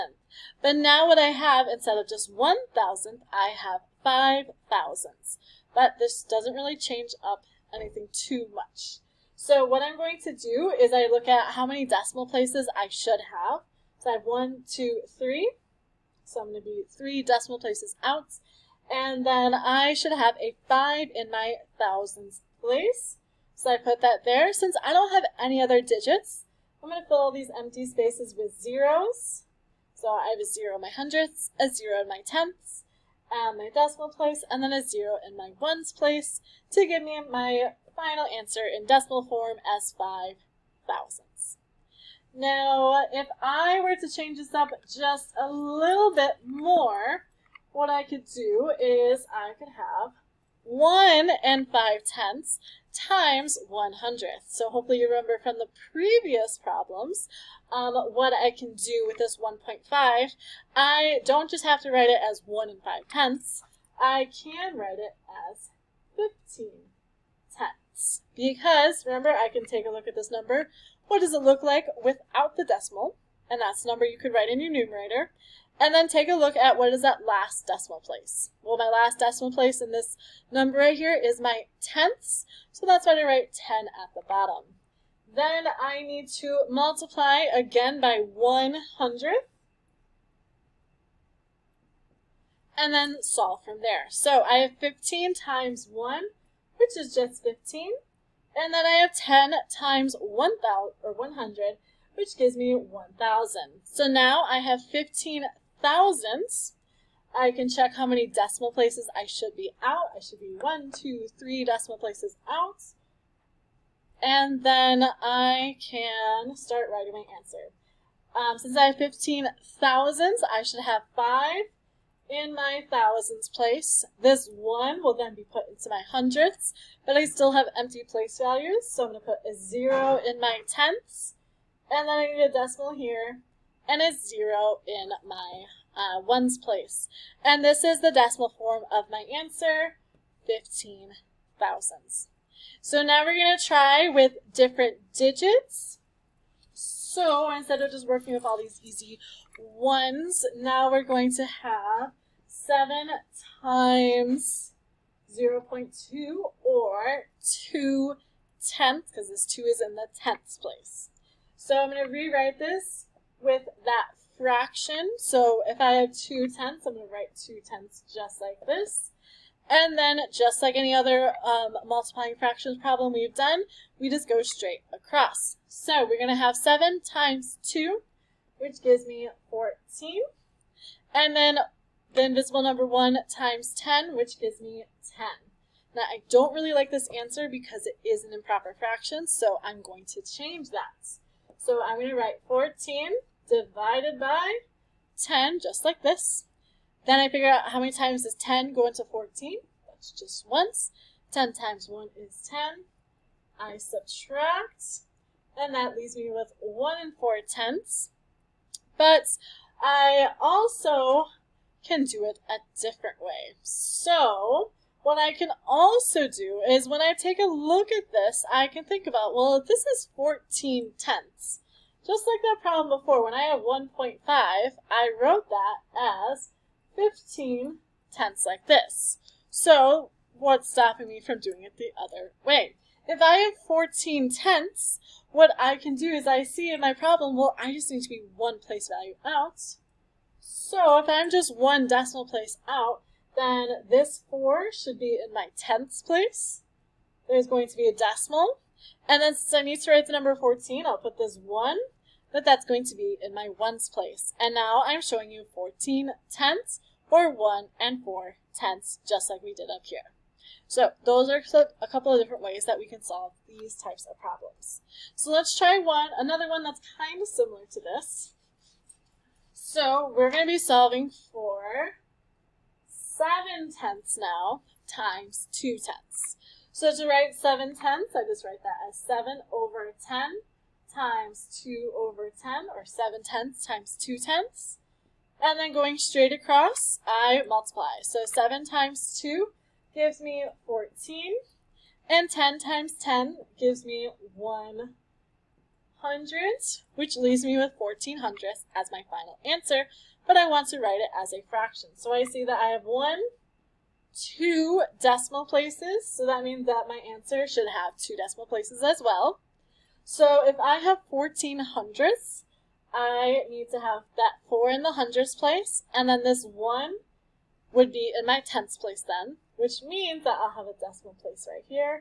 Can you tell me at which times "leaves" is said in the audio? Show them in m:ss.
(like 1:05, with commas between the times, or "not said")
3:25, 4:57.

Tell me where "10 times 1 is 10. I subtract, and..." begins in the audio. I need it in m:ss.
3:21.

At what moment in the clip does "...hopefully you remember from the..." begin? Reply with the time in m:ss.
0:54.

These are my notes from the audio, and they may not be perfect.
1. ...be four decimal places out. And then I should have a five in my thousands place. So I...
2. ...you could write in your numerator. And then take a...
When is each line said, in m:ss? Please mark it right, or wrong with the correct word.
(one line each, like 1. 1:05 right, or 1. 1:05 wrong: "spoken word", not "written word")
1. 0:16 wrong: "three", not "four"
2. 1:14 right.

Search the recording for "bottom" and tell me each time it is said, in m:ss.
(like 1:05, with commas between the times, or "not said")
1:24.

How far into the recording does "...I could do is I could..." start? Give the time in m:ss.
0:47.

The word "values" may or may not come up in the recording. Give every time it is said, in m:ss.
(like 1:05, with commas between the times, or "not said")
2:08, 3:58.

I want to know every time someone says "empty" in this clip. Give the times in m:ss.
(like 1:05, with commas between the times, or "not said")
0:27, 2:07.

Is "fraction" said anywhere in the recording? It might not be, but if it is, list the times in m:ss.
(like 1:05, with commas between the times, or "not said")
2:44, 2:52, 3:08, 5:01.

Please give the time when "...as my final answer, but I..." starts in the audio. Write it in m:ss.
4:58.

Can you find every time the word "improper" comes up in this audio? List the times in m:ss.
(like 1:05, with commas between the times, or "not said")
3:08.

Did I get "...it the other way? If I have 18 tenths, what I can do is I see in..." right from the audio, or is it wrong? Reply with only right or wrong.
wrong.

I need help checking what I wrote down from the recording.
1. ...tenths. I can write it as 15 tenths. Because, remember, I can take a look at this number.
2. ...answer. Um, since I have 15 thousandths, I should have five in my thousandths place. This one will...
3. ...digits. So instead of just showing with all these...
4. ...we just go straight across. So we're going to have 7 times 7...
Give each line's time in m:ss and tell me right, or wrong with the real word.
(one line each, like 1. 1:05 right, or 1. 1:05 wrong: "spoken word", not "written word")
1. 1:03 right
2. 1:57 right
3. 2:25 wrong: "working", not "showing"
4. 2:53 wrong: "2", not "7".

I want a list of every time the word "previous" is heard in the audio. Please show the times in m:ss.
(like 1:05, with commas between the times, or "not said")
0:55.